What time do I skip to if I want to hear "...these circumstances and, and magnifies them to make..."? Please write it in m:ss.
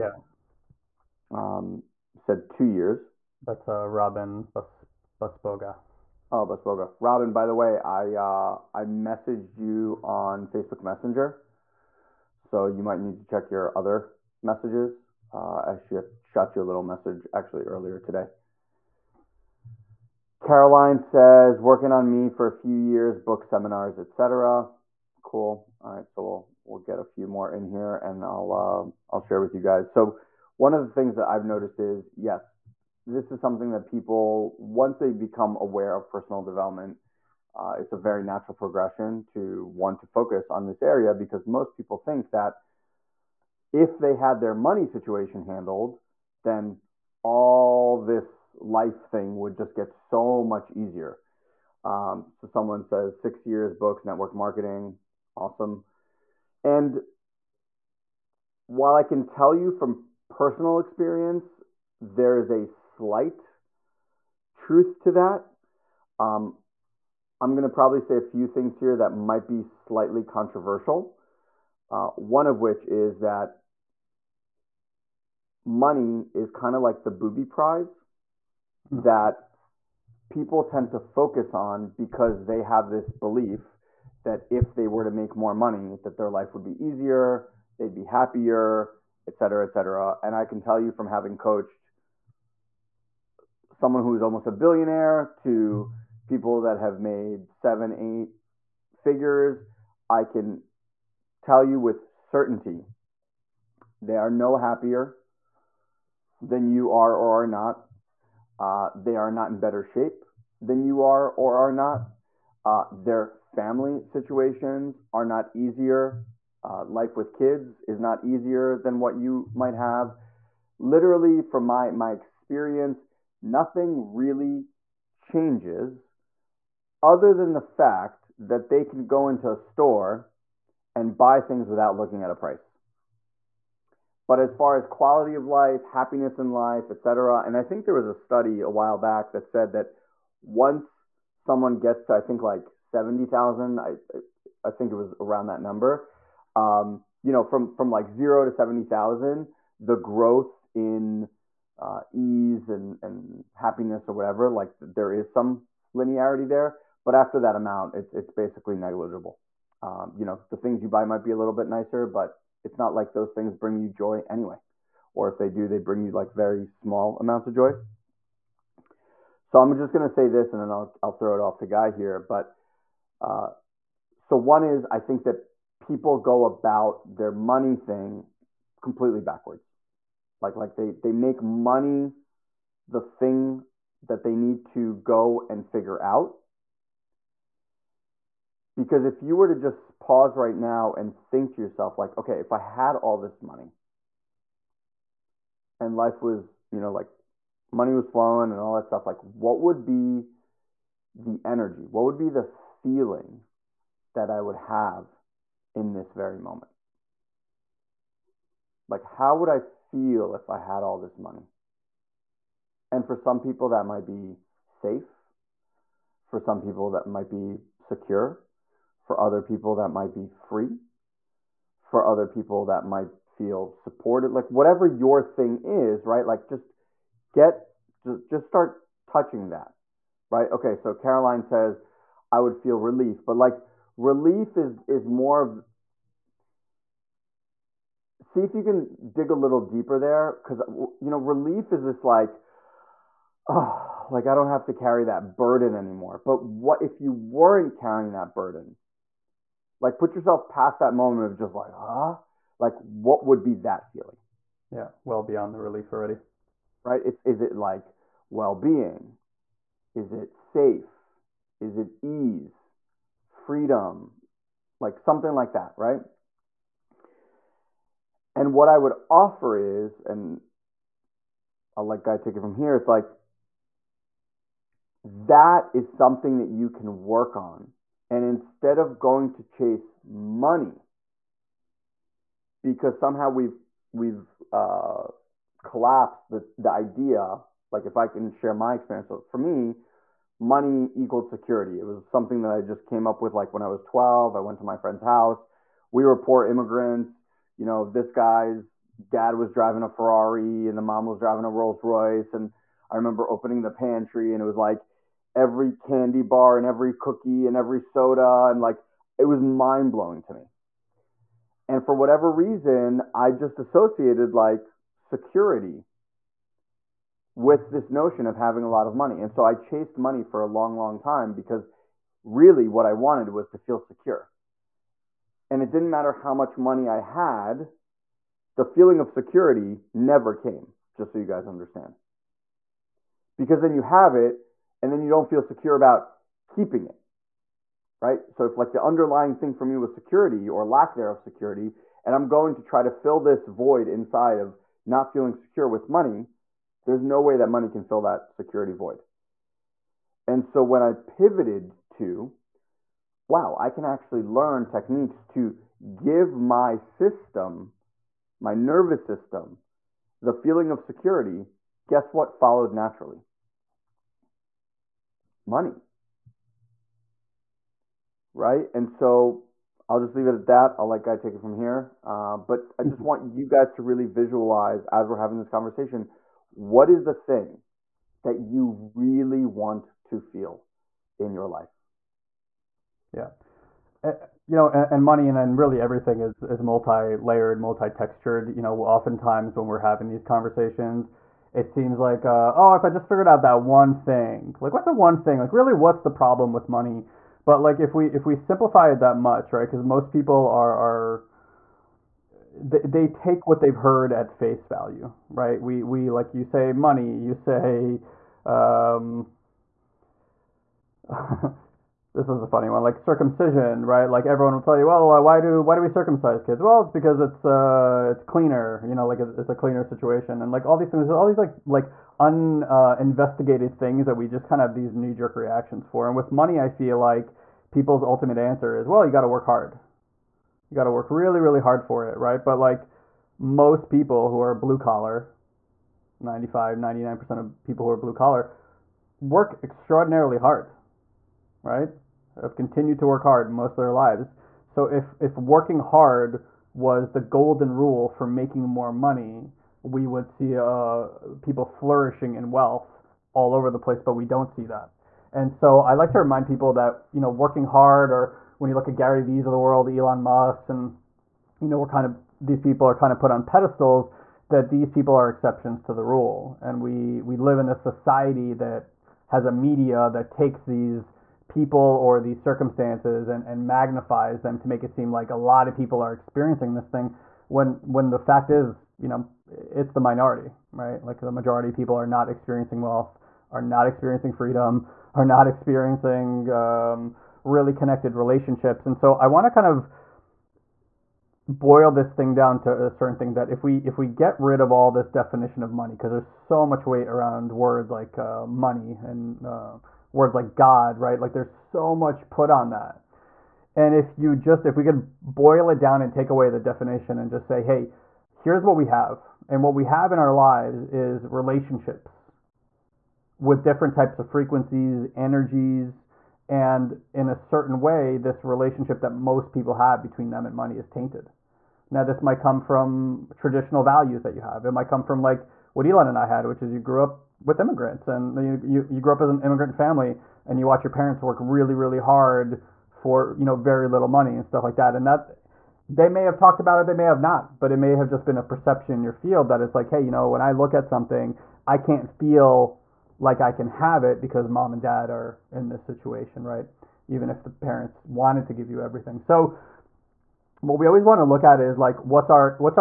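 7:52.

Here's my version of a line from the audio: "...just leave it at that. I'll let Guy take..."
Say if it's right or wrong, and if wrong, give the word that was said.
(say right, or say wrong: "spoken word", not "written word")
right.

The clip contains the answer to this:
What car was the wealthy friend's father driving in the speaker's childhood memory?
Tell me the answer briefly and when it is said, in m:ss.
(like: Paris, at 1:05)
Ferrari, at 4:59.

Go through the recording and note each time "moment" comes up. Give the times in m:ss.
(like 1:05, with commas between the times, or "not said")
3:26, 4:10.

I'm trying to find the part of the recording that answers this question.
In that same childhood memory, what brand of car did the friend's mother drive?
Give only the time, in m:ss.
5:01.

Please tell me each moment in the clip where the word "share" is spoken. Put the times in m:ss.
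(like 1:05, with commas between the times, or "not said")
0:29, 4:48.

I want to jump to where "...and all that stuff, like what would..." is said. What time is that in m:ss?
3:18.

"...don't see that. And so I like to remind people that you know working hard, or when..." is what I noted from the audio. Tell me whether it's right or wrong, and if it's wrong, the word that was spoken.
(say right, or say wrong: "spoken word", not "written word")
right.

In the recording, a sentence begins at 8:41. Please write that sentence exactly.
Now, this might come from traditional values that you have.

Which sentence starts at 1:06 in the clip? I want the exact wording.
Um, I'm going to probably say a few things here that might be slightly controversial.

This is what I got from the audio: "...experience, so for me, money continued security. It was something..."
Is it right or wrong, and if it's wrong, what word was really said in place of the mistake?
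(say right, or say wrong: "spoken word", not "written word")
wrong: "equaled", not "continued".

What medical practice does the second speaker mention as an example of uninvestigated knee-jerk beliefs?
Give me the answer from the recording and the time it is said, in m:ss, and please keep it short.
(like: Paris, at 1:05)
circumcision, at 6:52.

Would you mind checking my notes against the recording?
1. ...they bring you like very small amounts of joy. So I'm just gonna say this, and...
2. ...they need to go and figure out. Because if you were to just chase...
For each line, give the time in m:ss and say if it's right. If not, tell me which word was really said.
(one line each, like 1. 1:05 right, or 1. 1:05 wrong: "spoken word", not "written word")
1. 2:45 right
2. 3:04 wrong: "pause", not "chase".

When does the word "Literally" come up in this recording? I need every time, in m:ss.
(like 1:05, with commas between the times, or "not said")
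2:00.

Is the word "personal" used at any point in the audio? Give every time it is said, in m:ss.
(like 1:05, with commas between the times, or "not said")
0:36, 1:00.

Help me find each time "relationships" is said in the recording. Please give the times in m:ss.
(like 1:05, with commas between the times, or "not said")
8:08, 8:31, 8:38.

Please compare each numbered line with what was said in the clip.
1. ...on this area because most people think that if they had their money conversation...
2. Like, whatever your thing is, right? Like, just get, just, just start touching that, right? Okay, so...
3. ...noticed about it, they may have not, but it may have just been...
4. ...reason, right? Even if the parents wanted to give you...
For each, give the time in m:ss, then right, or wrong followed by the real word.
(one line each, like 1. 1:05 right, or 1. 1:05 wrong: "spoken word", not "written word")
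1. 0:40 wrong: "situation", not "conversation"
2. 3:44 right
3. 8:56 wrong: "talked", not "noticed"
4. 9:05 wrong: "situation", not "reason".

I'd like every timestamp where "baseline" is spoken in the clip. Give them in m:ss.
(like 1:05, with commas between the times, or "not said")
not said.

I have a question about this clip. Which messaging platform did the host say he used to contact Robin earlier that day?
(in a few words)
Facebook Messenger.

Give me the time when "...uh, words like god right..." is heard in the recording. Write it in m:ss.
8:19.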